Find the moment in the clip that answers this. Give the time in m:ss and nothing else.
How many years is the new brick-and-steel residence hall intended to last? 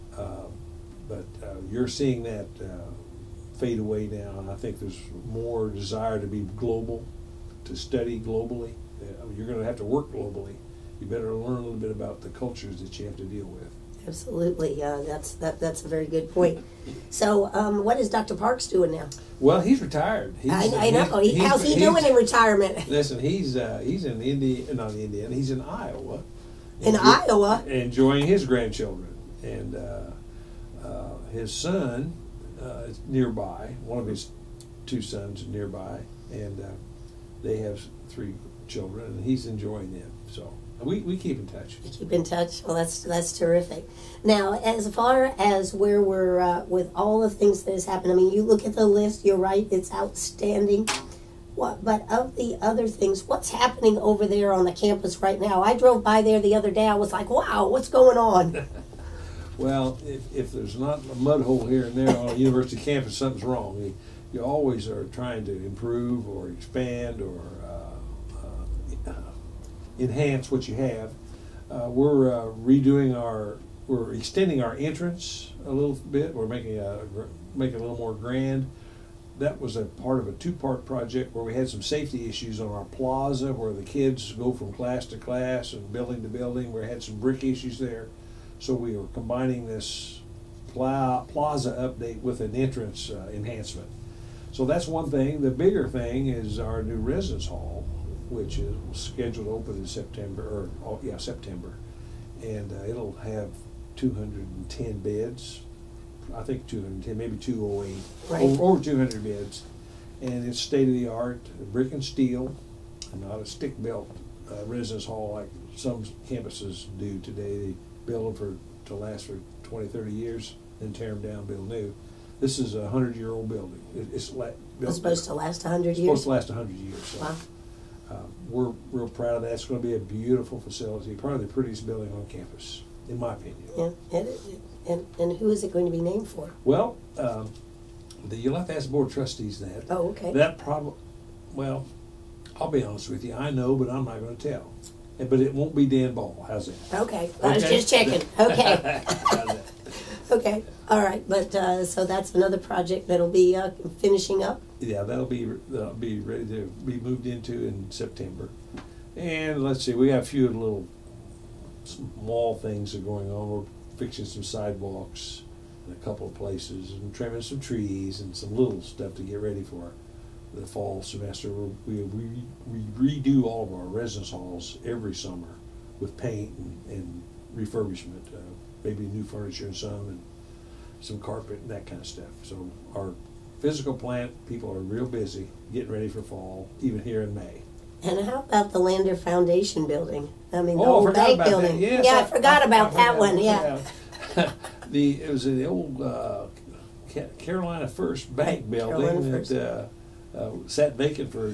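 2:06.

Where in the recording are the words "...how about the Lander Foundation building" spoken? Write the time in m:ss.
3:08.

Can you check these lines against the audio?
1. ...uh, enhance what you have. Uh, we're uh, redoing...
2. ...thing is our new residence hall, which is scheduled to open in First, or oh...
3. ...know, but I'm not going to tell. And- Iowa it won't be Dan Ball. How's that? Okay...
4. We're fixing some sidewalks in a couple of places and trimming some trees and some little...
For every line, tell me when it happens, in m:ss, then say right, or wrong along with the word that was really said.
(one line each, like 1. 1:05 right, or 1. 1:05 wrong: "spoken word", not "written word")
1. 1:09 right
2. 1:35 wrong: "September", not "First"
3. 2:23 wrong: "But", not "Iowa"
4. 2:43 right.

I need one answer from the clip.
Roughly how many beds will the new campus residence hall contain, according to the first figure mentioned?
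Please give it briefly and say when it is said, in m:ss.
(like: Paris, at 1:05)
210, at 1:43.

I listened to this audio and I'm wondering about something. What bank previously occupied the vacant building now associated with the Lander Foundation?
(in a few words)
Carolina First Bank.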